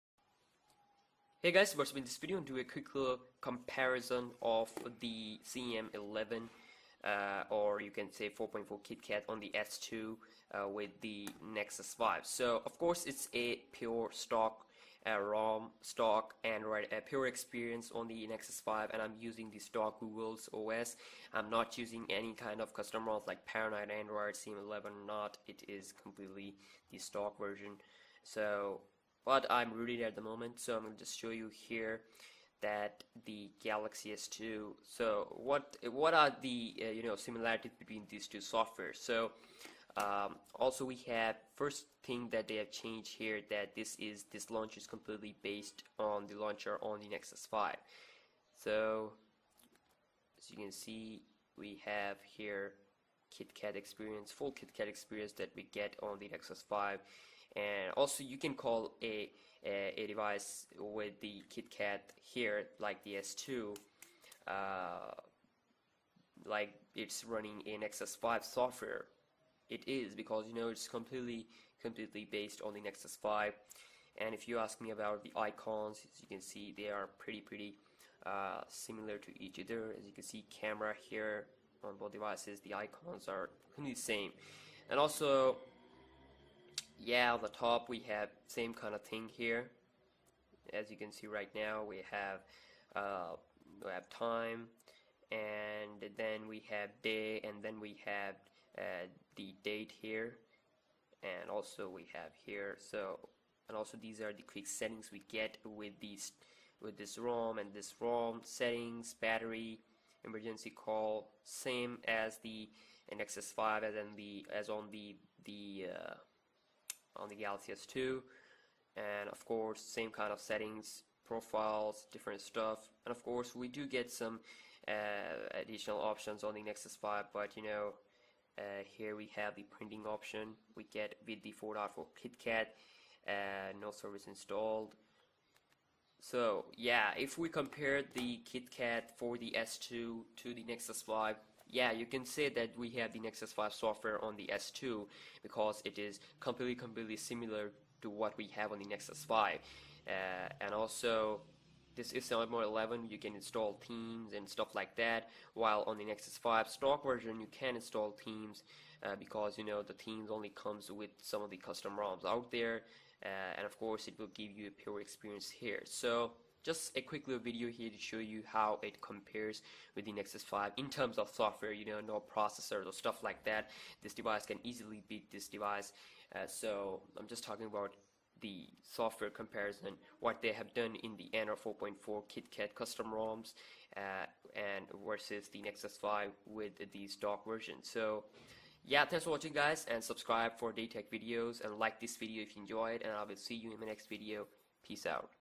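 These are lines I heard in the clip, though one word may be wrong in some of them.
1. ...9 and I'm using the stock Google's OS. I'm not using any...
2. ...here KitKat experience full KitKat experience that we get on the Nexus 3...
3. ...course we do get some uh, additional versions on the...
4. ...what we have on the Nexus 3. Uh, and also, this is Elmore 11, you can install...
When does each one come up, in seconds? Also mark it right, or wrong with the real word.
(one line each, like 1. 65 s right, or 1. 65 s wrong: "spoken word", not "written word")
1. 18 s wrong: "5", not "9"
2. 52 s wrong: "5", not "3"
3. 123 s wrong: "options", not "versions"
4. 148 s wrong: "5", not "3".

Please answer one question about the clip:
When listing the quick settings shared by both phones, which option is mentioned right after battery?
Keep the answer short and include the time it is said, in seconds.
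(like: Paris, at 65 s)
emergency call, at 110 s.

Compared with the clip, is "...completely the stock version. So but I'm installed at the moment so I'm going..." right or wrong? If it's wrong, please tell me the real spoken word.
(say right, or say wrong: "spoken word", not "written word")
wrong: "rooted", not "installed".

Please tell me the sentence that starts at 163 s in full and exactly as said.
Uh, and of course, it will give you a pure experience here.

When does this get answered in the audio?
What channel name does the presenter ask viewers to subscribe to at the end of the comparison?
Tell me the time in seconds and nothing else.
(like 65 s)
190 s.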